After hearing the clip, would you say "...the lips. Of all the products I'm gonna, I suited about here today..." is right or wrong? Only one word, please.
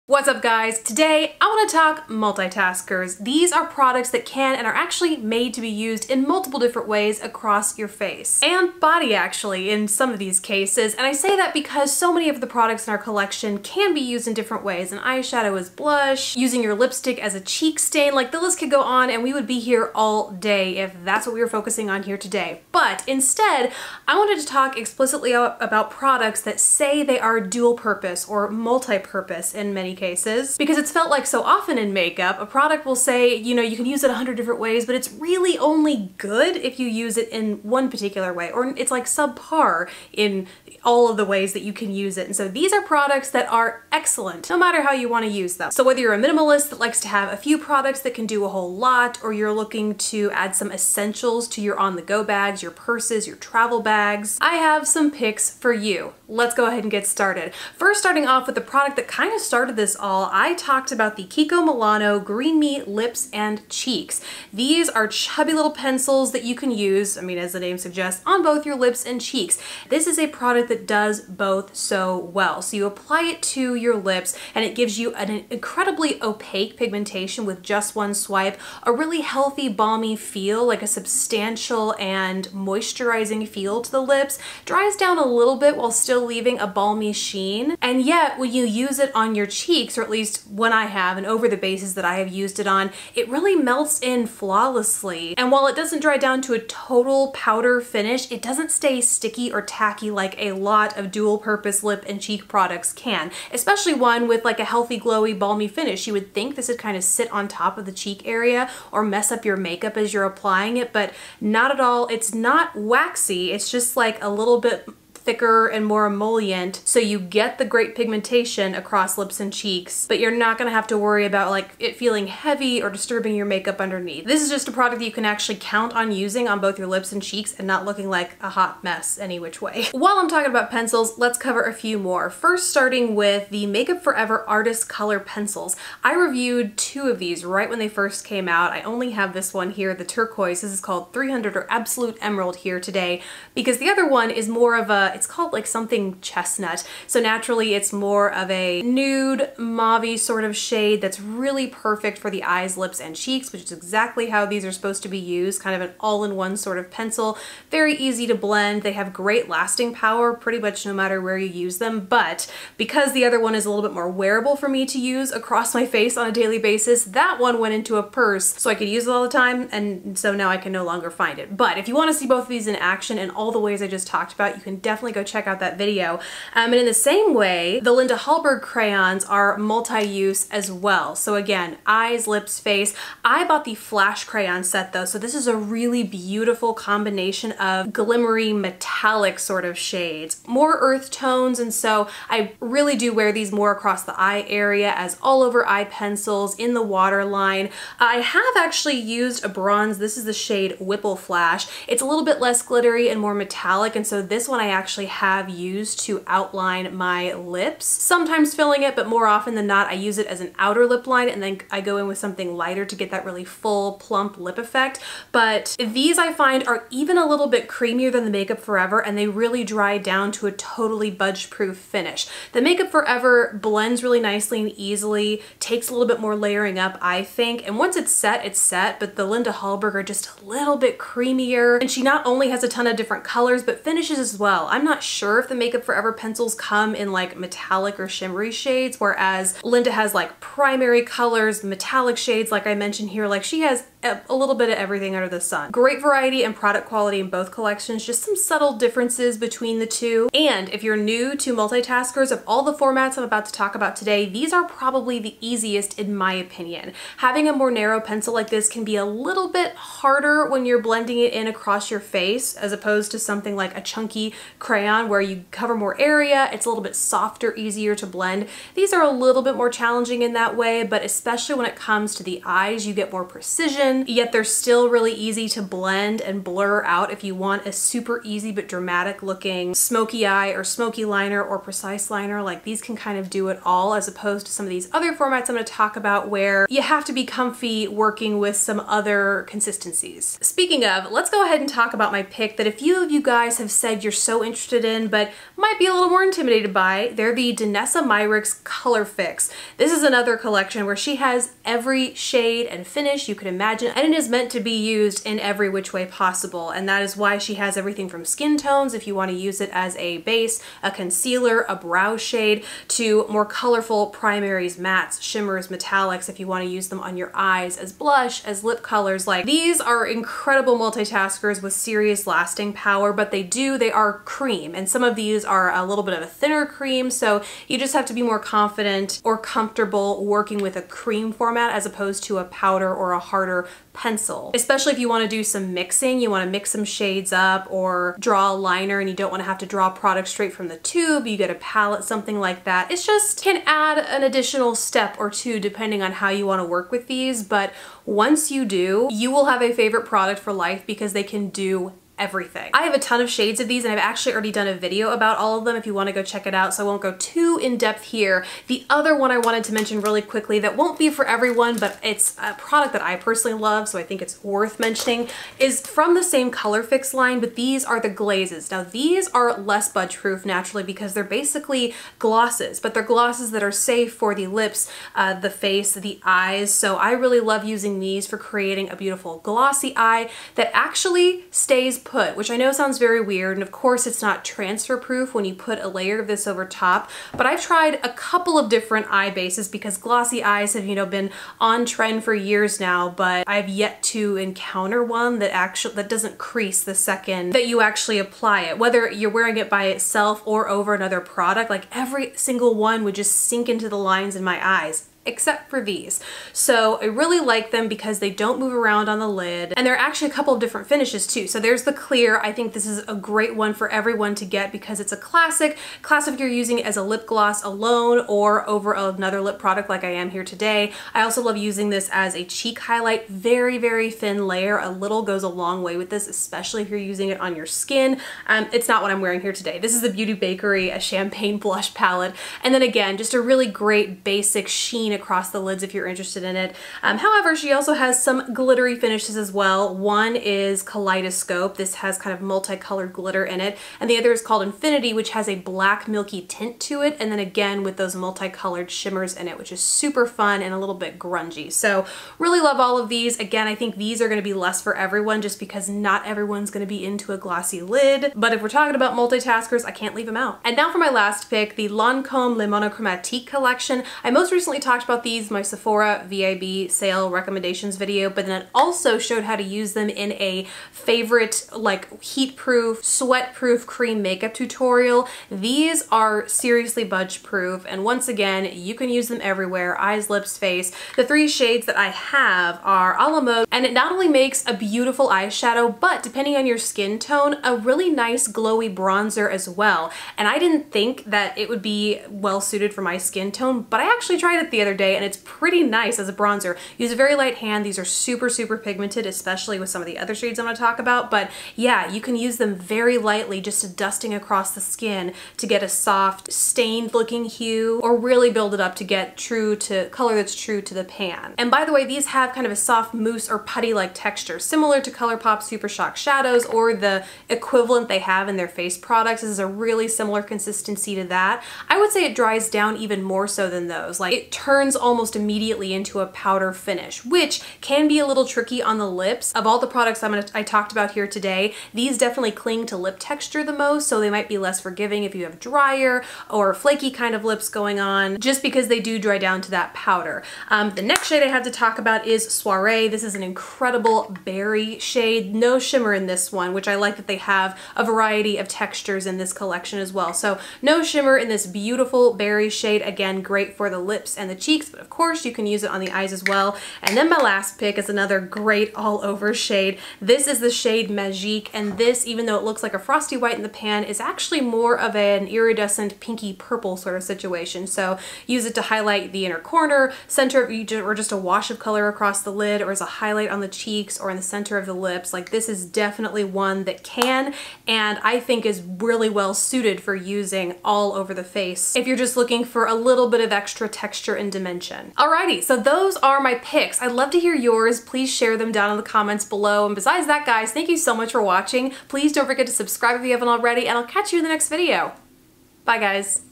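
wrong.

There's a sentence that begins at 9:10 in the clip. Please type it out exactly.
So no shimmer in this beautiful berry shade.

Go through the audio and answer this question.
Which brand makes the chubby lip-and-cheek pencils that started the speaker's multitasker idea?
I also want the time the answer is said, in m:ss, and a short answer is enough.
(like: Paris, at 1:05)
Kiko Milano, at 1:01.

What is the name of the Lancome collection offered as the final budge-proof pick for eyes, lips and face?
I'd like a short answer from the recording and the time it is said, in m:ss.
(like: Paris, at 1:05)
Le Monochromatique, at 7:42.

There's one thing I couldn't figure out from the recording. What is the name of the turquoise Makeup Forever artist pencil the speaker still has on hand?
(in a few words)
Absolute Emerald.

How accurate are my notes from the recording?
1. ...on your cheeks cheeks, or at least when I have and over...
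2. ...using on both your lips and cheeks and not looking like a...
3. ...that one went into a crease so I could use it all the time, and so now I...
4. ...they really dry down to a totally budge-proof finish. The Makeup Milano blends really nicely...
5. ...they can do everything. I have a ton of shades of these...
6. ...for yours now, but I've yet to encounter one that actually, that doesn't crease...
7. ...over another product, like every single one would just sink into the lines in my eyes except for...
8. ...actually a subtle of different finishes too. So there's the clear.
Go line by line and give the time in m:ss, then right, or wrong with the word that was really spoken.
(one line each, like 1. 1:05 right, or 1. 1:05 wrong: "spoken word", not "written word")
1. 1:29 right
2. 2:06 right
3. 2:47 wrong: "purse", not "crease"
4. 3:39 wrong: "Forever", not "Milano"
5. 5:51 right
6. 6:32 wrong: "years", not "yours"
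7. 6:40 right
8. 6:49 wrong: "couple", not "subtle".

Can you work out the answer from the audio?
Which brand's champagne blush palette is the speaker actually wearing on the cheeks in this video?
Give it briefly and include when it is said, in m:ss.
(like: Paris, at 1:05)
Beauty Bakerie, at 7:10.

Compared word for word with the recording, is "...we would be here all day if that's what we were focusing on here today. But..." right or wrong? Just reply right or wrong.
right.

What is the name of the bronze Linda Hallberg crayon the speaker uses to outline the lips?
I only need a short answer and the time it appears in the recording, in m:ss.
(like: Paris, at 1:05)
Whipple Flash, at 3:20.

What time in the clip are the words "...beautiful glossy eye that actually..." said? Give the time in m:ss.
6:18.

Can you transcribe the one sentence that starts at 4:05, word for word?
Great variety and product quality in both collections, just some subtle differences between the two.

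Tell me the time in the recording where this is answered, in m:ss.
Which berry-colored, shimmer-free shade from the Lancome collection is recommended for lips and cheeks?
9:02.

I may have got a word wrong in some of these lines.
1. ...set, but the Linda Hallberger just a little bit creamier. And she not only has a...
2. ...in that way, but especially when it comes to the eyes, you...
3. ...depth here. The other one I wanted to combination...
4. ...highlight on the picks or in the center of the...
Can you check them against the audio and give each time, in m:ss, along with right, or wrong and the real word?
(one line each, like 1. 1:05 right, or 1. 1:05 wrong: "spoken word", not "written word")
1. 3:48 right
2. 4:30 right
3. 5:57 wrong: "mention", not "combination"
4. 9:33 wrong: "cheeks", not "picks".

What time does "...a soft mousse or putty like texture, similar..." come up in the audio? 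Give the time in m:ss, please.
8:32.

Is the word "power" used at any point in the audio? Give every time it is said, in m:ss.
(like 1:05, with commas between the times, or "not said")
2:39, 5:22.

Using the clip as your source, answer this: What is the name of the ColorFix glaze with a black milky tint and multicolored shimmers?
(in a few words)
Infinity.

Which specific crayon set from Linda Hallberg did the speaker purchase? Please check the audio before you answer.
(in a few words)
flash crayon set.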